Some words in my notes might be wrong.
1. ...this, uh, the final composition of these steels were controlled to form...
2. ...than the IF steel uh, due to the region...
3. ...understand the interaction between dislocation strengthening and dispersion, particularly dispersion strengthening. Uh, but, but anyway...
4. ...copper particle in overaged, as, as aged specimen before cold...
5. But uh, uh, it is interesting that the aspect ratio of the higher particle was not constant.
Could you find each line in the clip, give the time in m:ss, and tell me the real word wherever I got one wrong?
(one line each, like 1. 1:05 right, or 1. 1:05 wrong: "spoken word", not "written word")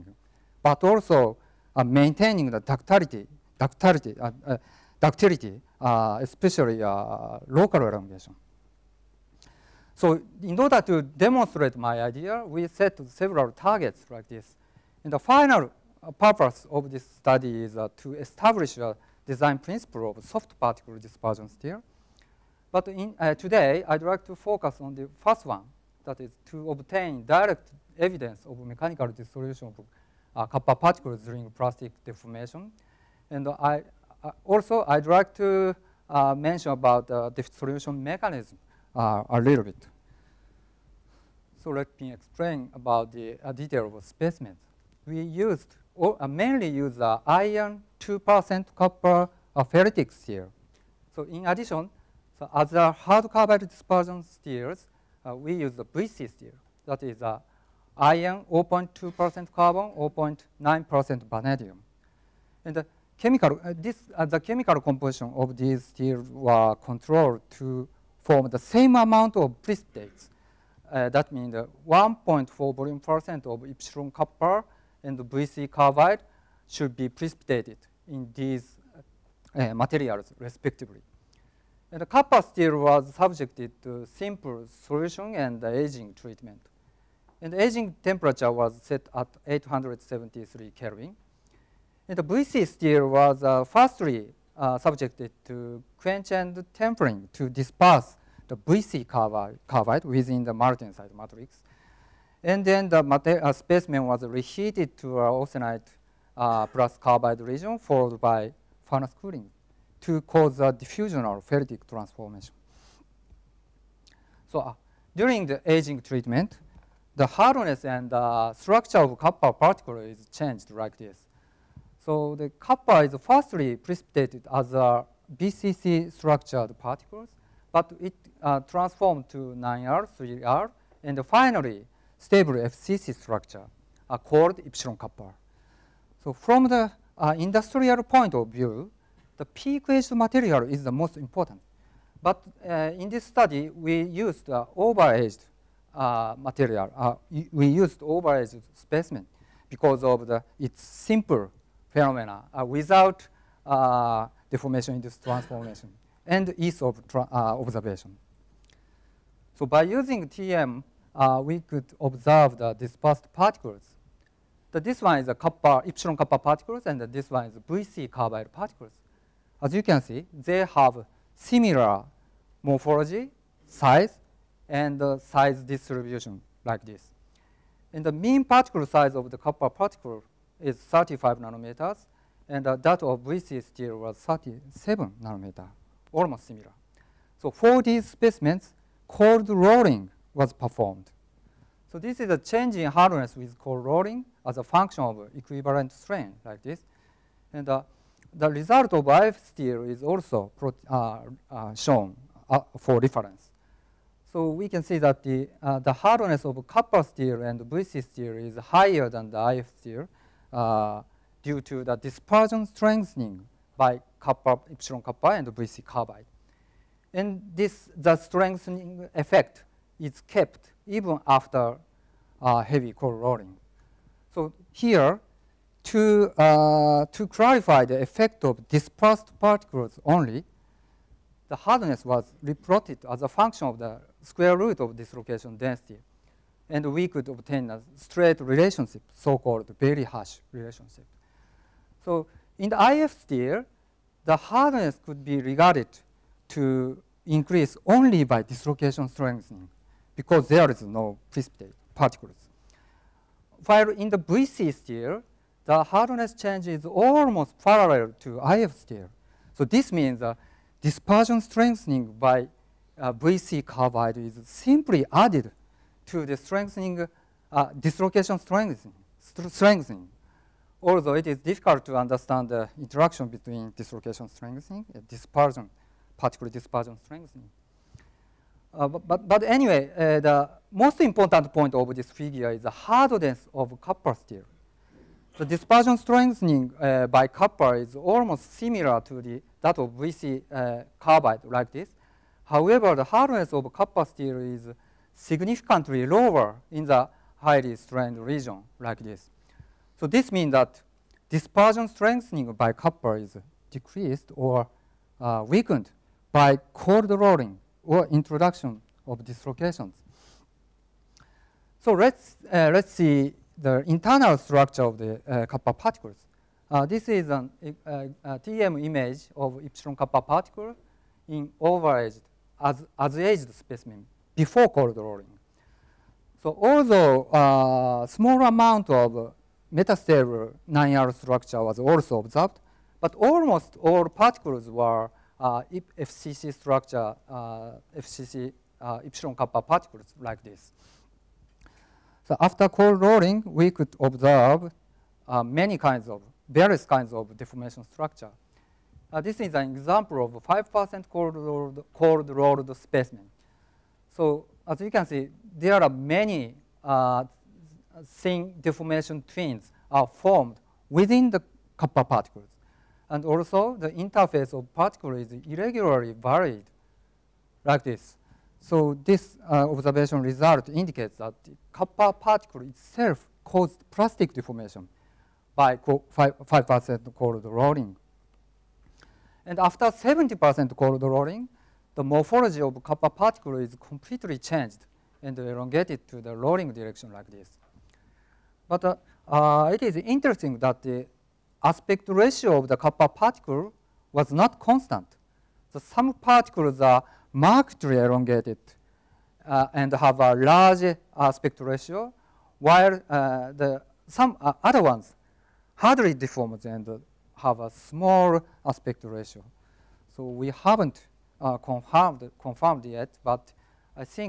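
1. 1:03 wrong: "chemical", not "final"
2. 3:29 wrong: "dispersion", not "region"
3. 4:31 right
4. 5:19 right
5. 6:28 wrong: "copper", not "higher".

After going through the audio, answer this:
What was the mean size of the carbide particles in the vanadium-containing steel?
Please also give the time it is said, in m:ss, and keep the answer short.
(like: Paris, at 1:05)
37 nanometers, at 3:04.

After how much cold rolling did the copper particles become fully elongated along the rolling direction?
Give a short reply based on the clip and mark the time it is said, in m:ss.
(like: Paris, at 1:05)
70%, at 6:19.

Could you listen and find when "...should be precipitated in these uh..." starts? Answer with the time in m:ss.
1:16.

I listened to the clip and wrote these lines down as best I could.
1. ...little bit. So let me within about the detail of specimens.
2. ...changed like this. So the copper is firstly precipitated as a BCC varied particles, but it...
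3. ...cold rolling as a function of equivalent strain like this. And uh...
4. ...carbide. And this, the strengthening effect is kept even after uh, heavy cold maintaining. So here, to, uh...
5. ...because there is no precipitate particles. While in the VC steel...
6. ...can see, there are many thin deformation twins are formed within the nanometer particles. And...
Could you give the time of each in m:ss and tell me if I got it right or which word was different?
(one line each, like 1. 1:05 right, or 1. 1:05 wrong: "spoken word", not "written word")
1. 0:39 wrong: "explain", not "within"
2. 2:00 wrong: "structured", not "varied"
3. 3:13 right
4. 3:35 wrong: "rolling", not "maintaining"
5. 4:10 right
6. 5:54 wrong: "copper", not "nanometer".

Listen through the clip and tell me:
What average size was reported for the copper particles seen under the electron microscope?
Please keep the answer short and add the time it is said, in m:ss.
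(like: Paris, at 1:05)
35 nanometers, at 3:00.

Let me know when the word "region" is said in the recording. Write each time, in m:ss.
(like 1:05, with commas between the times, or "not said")
1:47, 4:58.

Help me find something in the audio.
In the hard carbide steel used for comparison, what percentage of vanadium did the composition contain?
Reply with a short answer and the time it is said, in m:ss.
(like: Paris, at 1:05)
0.9%, at 1:00.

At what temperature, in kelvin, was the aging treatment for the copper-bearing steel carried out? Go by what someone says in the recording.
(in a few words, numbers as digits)
873 Kelvin.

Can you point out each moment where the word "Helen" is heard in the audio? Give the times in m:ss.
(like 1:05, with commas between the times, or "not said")
not said.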